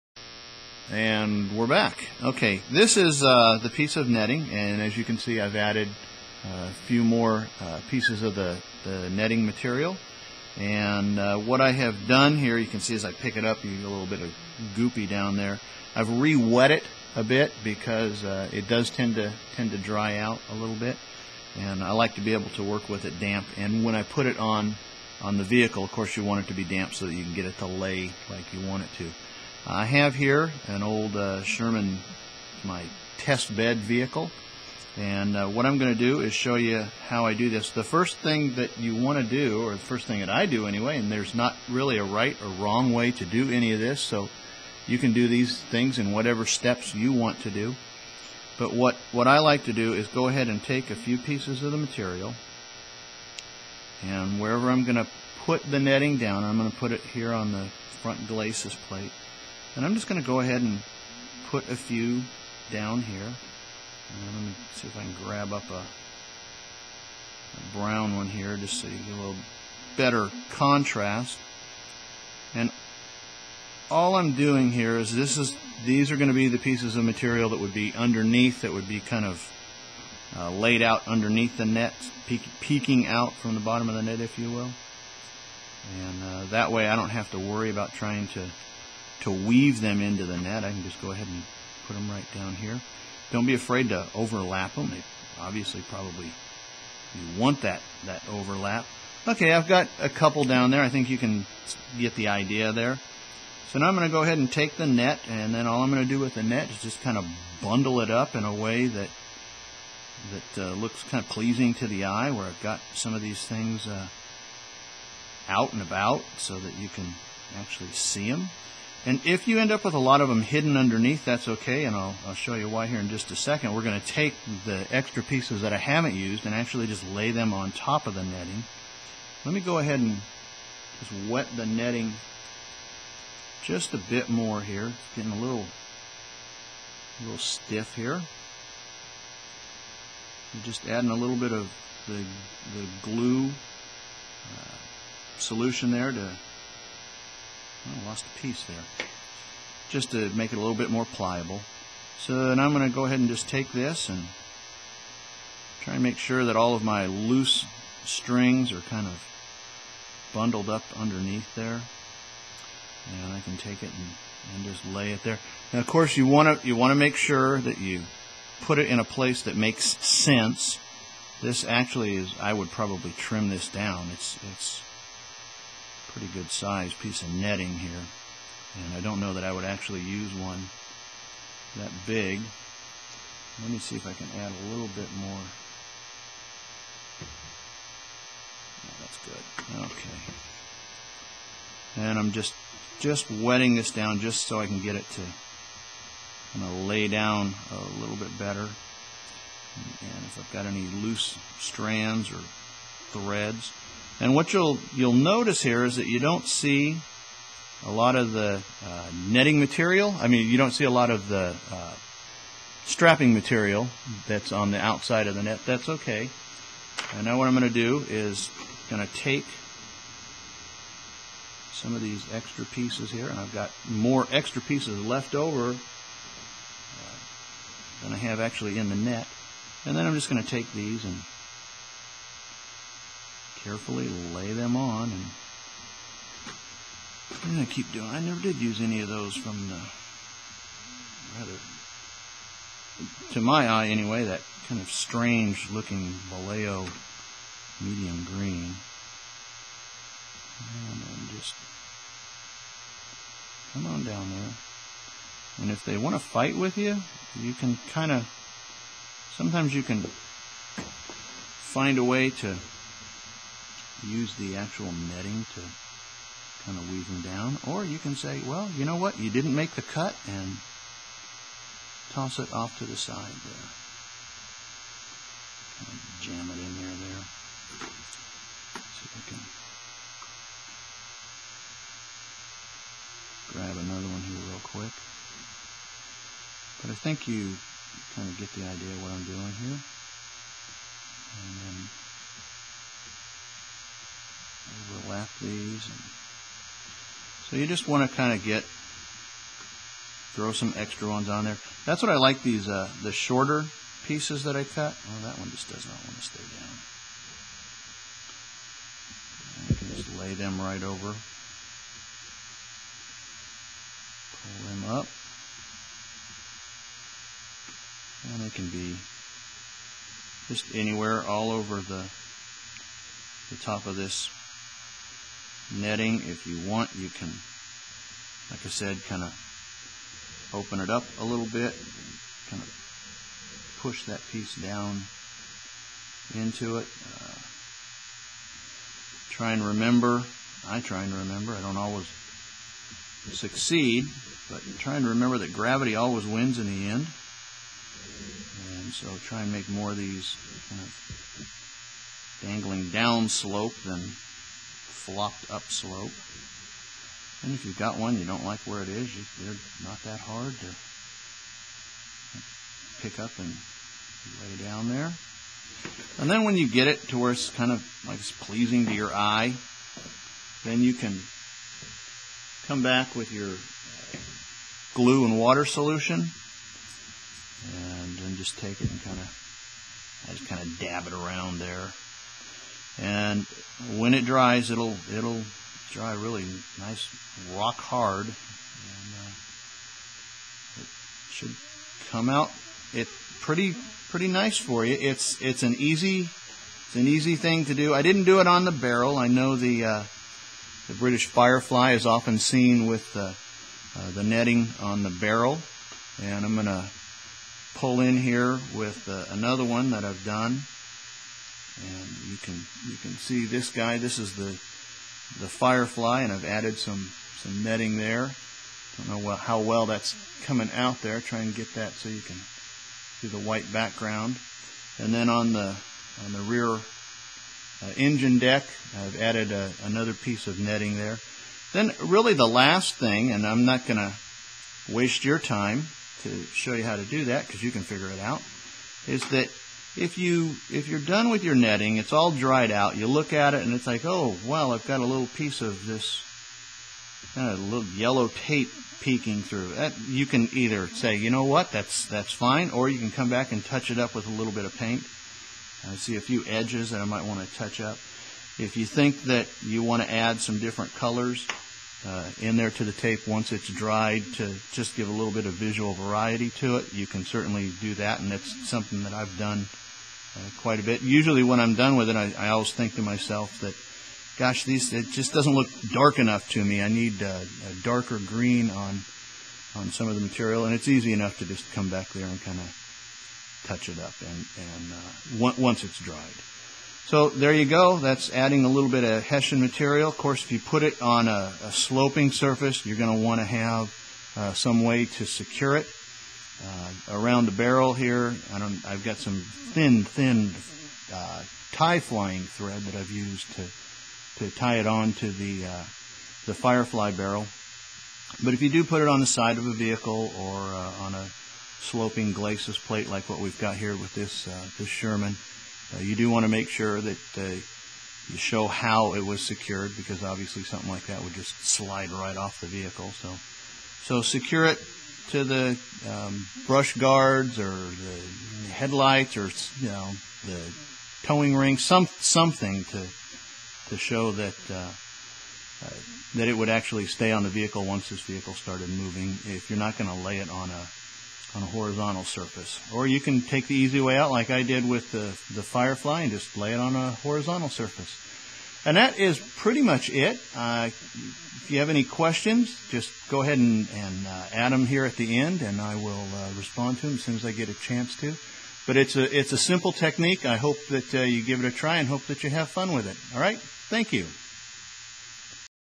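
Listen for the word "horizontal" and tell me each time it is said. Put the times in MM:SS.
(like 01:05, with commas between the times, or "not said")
09:01, 09:07.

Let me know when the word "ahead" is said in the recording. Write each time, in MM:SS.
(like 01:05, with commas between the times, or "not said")
00:50, 01:00, 01:31, 01:44, 02:09, 02:33, 09:13.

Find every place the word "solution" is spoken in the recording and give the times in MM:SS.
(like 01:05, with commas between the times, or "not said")
02:25, 06:15.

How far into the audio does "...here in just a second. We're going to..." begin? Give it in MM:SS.
02:02.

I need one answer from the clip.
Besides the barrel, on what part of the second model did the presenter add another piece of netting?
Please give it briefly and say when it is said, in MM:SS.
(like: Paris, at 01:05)
engine deck, at 07:07.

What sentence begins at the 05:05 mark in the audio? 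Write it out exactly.
Well, that one just does not want to stay down.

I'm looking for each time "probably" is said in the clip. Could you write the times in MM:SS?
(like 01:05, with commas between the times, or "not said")
01:35, 02:52.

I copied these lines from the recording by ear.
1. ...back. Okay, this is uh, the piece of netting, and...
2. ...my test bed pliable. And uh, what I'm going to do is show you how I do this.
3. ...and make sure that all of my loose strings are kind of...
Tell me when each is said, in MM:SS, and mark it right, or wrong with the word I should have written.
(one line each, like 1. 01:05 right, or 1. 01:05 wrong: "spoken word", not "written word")
1. 00:01 right
2. 00:32 wrong: "vehicle", not "pliable"
3. 02:35 right.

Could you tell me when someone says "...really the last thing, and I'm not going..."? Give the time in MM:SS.
07:12.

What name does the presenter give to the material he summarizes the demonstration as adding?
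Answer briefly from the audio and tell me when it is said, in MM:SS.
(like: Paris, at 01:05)
Hessian material, at 08:09.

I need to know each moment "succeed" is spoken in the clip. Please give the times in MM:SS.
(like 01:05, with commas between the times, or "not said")
05:43.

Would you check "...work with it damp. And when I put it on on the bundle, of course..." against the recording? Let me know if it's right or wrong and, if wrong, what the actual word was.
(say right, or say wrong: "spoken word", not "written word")
wrong: "vehicle", not "bundle".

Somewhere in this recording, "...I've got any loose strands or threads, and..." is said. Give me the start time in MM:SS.
03:20.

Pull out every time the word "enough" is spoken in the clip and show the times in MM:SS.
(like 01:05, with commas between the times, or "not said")
07:56, 08:01.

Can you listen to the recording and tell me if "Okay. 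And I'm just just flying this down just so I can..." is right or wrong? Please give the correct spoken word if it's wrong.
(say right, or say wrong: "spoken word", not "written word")
wrong: "wetting", not "flying".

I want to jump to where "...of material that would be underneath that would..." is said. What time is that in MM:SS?
01:16.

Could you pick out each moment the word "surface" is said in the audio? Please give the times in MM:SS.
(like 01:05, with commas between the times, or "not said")
08:12, 09:02, 09:07.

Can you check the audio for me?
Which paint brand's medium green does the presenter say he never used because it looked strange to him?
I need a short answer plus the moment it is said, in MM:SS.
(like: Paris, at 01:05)
Vallejo, at 04:06.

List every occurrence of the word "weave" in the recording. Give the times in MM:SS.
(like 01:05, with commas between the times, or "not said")
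01:29, 04:26.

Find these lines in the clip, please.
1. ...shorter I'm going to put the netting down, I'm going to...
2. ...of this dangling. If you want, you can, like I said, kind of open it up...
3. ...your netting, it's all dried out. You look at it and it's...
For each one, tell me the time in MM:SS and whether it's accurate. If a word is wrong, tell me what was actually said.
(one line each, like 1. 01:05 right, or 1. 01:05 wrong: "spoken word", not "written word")
1. 00:54 wrong: "wherever", not "shorter"
2. 05:23 wrong: "netting", not "dangling"
3. 07:21 right.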